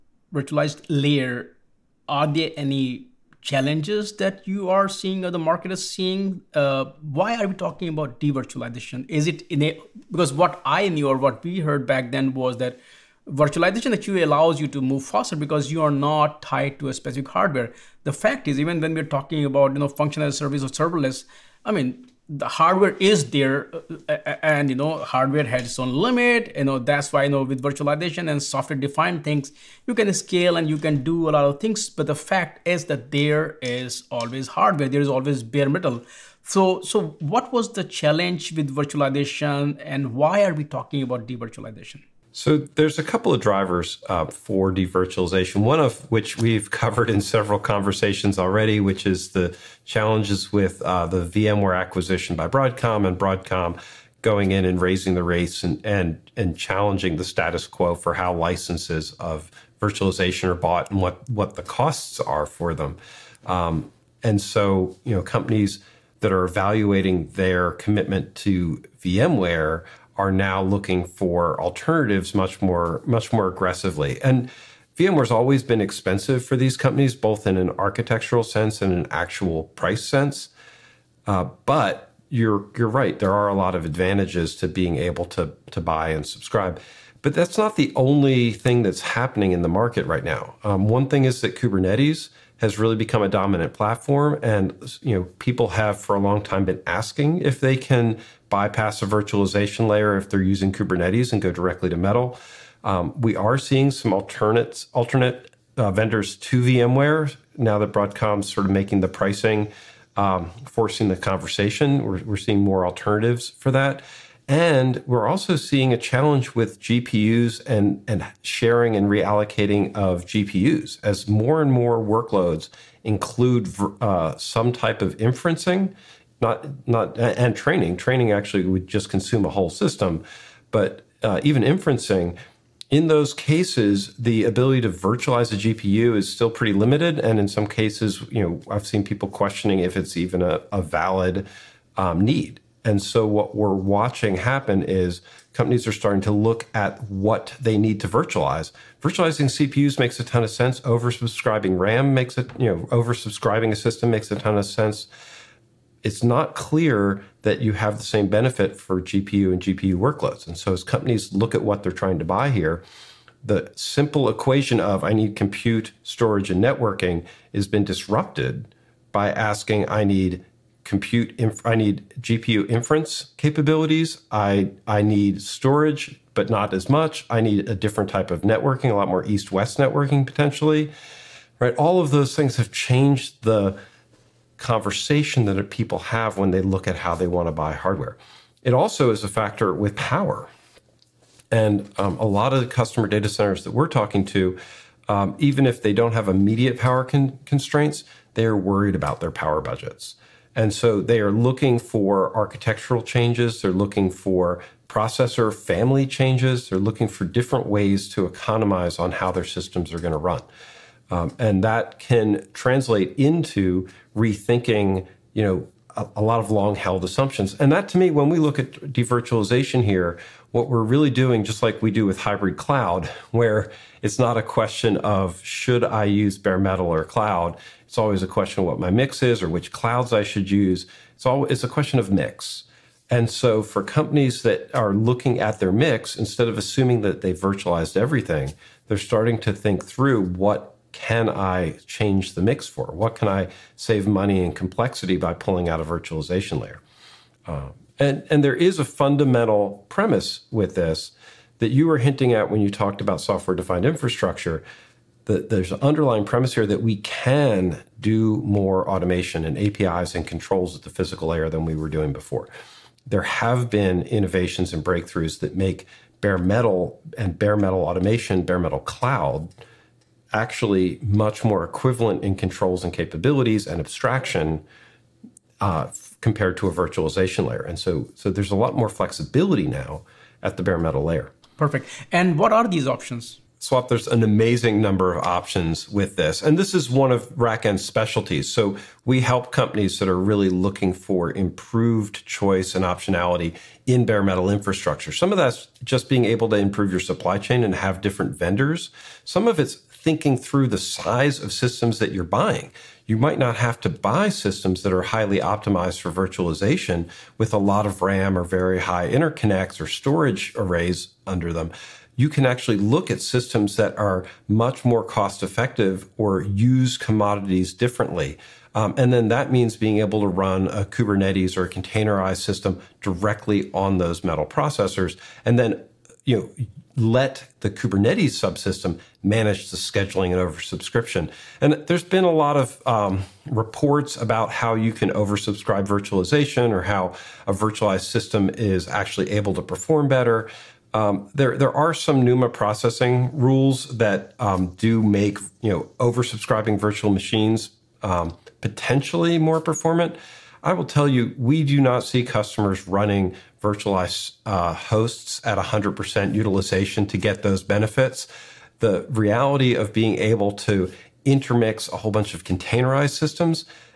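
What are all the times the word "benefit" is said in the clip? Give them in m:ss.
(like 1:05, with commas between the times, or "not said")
2:38, 5:57.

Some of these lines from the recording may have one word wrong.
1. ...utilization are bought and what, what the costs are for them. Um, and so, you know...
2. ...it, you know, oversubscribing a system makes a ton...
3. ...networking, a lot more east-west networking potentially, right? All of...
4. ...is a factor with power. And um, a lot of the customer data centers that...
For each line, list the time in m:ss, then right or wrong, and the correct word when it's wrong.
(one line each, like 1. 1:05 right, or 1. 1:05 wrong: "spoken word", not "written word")
1. 0:59 wrong: "virtualization", not "utilization"
2. 2:32 right
3. 2:58 right
4. 3:09 right.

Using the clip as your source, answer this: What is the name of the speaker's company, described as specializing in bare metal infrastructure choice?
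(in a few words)
RackN.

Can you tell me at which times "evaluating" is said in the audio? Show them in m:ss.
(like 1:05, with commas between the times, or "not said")
1:06.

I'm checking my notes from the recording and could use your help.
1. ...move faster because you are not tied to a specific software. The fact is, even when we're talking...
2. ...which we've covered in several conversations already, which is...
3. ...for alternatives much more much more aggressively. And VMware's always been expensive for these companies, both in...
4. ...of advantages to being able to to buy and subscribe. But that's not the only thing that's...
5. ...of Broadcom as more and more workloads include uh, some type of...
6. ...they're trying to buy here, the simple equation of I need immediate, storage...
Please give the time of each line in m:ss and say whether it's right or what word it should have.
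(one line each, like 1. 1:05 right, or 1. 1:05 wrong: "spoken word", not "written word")
1. 0:14 wrong: "hardware", not "software"
2. 0:46 right
3. 1:11 right
4. 1:23 right
5. 1:59 wrong: "GPUs", not "Broadcom"
6. 2:41 wrong: "compute", not "immediate".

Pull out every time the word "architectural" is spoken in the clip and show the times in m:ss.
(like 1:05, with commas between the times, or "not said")
1:17, 3:22.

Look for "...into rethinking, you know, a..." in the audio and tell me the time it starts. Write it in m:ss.
3:33.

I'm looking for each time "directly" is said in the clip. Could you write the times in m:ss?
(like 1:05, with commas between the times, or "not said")
1:41, 5:23.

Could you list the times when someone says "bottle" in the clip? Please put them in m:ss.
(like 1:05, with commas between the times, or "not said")
not said.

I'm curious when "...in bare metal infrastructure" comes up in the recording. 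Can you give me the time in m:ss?
4:53.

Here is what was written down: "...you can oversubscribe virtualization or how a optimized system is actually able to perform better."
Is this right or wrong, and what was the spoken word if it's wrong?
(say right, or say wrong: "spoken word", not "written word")
wrong: "virtualized", not "optimized".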